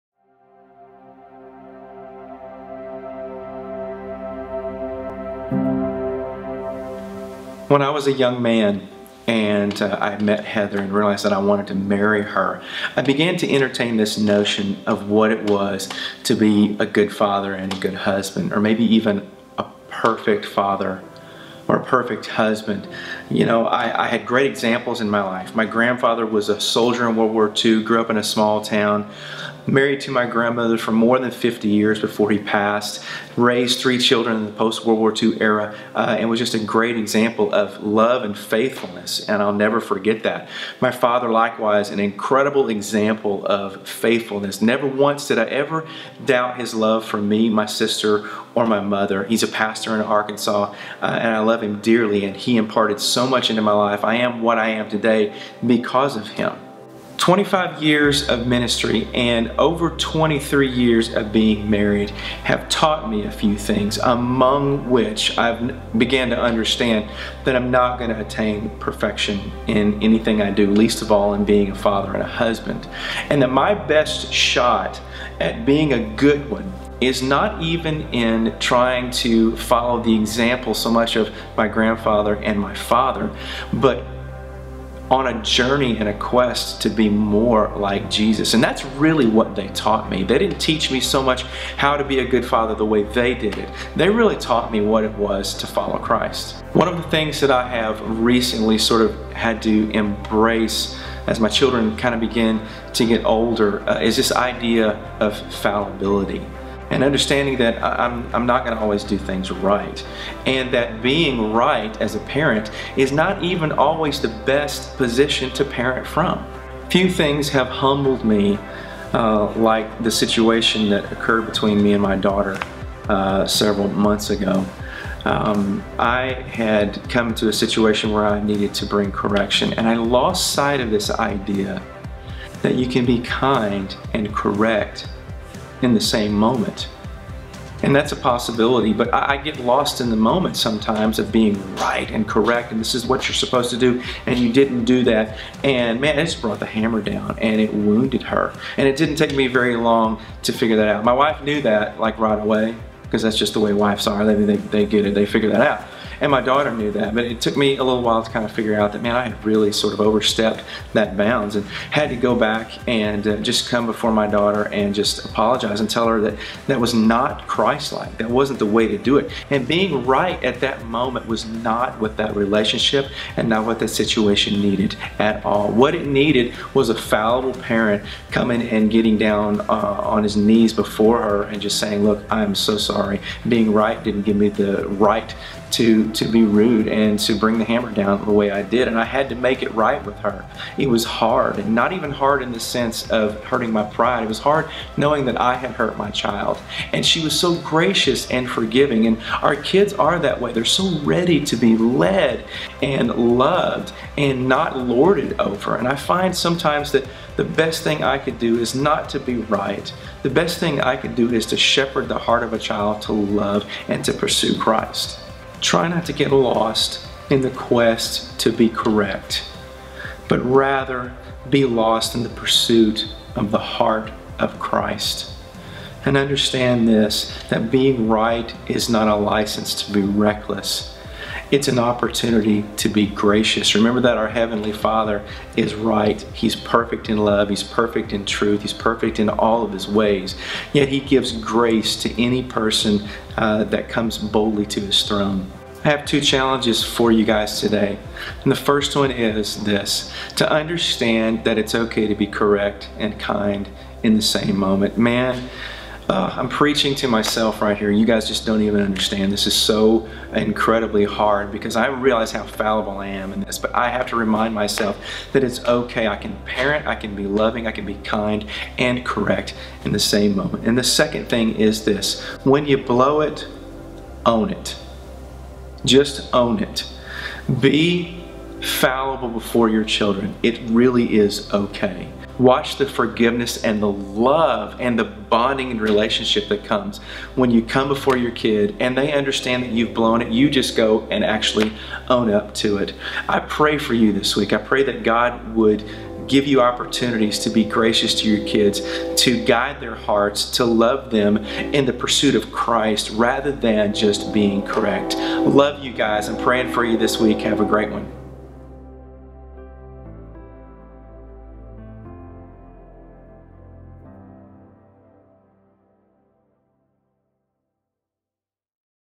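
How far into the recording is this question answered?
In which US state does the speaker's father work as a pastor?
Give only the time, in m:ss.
0:50.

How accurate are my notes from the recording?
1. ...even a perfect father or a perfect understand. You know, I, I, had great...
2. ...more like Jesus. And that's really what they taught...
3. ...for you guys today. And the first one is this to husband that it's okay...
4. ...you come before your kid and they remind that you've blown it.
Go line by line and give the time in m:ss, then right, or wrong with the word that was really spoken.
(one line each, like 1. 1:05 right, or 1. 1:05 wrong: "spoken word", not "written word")
1. 0:18 wrong: "husband", not "understand"
2. 1:27 right
3. 4:06 wrong: "understand", not "husband"
4. 4:47 wrong: "understand", not "remind".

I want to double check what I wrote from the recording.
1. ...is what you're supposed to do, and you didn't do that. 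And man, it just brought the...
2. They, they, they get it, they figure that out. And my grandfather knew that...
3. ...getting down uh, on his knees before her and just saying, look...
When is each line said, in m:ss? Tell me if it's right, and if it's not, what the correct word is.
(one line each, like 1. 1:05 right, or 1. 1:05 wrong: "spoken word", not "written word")
1. 2:22 right
2. 2:34 wrong: "daughter", not "grandfather"
3. 2:58 right.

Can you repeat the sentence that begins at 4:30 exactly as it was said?
And the second thing is this when you blow it, own it.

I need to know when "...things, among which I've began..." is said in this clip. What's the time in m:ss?
1:03.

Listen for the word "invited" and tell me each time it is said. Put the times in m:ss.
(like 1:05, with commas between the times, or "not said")
not said.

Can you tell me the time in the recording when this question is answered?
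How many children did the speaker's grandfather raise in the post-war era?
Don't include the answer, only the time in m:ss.
0:33.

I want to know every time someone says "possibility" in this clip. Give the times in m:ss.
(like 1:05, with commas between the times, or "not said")
2:18.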